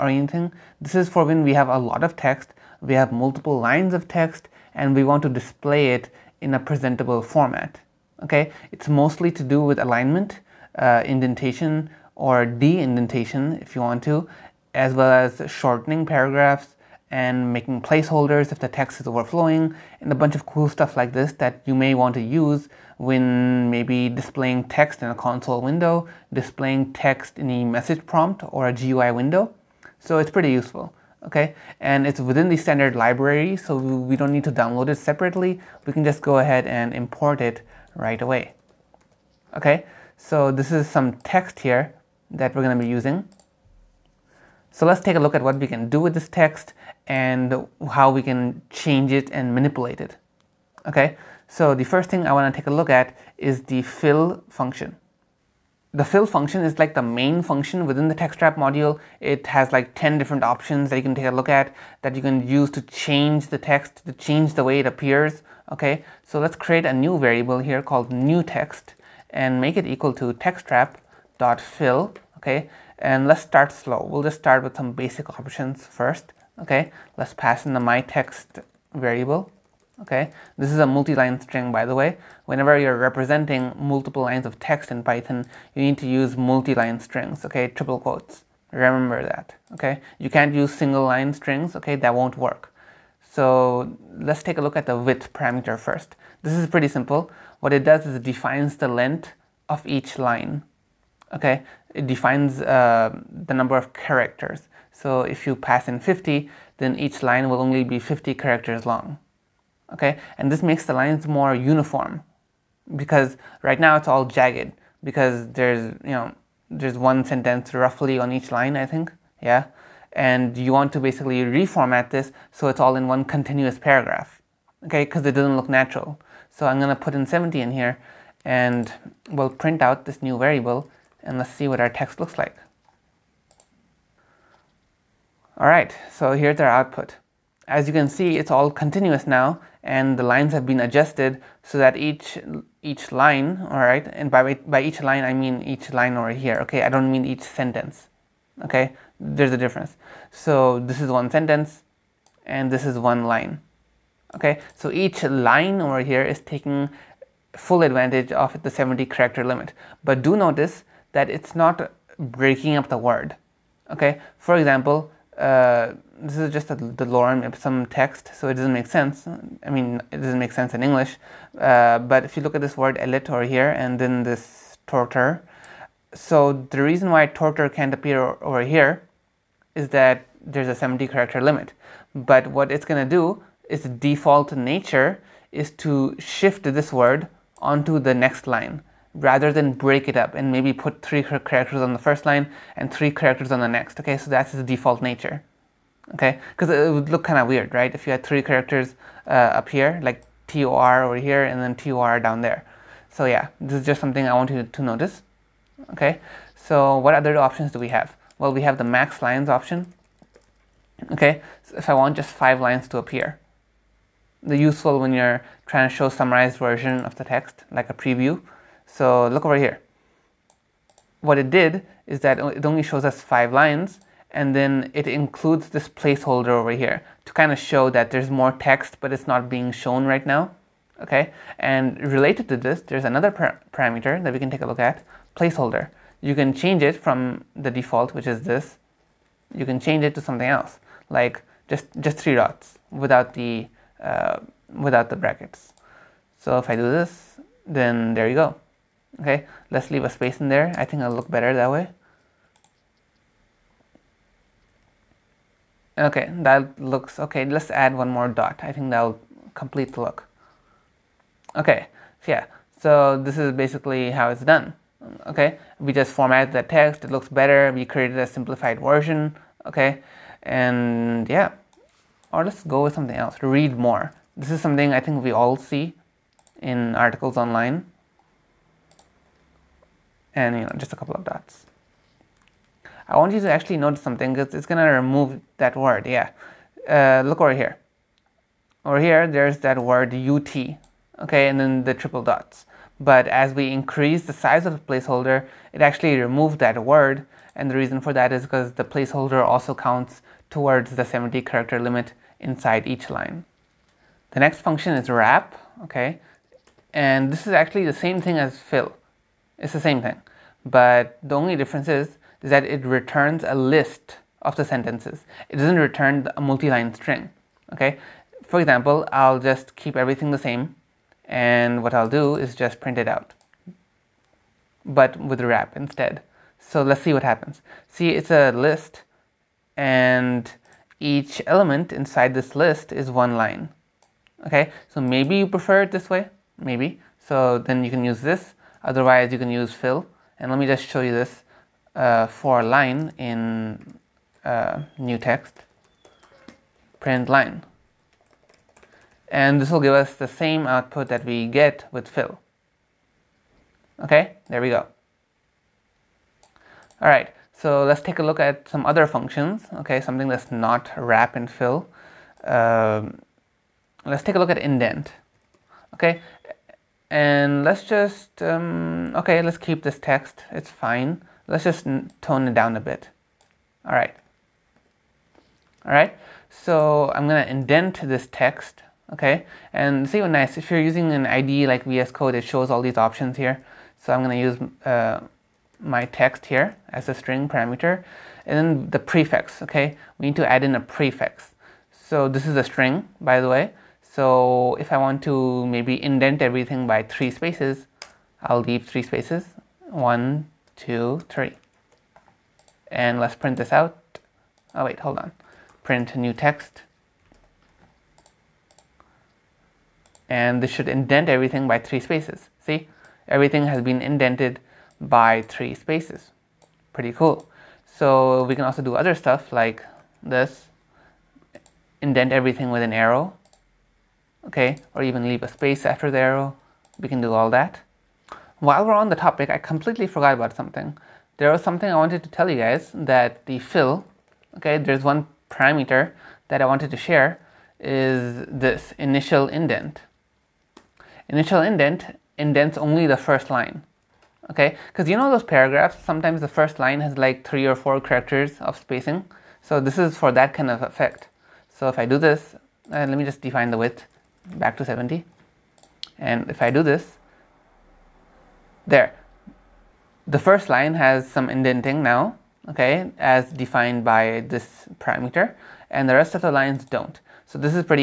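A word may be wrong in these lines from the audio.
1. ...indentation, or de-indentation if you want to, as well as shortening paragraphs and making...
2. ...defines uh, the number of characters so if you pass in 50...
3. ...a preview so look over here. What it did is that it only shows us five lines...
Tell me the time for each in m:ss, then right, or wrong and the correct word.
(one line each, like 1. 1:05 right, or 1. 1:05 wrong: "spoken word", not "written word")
1. 0:11 right
2. 1:42 right
3. 3:37 right.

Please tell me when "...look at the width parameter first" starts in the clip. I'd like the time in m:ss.
1:34.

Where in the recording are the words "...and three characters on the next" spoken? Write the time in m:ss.
3:12.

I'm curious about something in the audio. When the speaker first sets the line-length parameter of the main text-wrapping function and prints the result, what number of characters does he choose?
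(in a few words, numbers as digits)
70.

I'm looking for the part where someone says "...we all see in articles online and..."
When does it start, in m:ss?
4:35.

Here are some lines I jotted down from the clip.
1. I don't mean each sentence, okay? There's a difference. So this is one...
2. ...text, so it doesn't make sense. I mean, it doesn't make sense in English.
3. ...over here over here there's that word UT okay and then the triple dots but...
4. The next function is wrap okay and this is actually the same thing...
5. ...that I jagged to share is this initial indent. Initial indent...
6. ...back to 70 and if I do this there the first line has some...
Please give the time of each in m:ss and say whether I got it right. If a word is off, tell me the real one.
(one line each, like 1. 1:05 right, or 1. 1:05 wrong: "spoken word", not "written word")
1. 2:26 right
2. 2:47 right
3. 4:47 right
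4. 5:04 right
5. 7:16 wrong: "wanted", not "jagged"
6. 7:34 right.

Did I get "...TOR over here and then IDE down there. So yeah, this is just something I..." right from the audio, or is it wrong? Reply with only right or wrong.
wrong.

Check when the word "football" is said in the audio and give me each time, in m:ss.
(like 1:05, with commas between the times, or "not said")
not said.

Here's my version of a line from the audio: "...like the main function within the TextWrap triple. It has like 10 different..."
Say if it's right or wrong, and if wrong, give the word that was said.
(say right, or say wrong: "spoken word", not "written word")
wrong: "module", not "triple".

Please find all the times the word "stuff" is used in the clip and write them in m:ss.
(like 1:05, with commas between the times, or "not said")
0:20, 6:59.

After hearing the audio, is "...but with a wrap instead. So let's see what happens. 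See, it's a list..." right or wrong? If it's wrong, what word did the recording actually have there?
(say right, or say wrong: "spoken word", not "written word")
right.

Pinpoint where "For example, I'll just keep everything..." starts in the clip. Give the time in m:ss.
5:18.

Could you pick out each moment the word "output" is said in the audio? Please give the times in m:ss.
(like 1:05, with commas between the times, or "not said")
2:16, 5:50.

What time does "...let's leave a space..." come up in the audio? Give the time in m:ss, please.
4:09.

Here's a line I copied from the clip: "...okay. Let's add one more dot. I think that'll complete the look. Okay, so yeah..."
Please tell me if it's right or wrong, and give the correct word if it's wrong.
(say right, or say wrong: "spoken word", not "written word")
right.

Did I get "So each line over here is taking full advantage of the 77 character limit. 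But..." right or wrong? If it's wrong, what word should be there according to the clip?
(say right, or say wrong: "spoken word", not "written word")
wrong: "70", not "77".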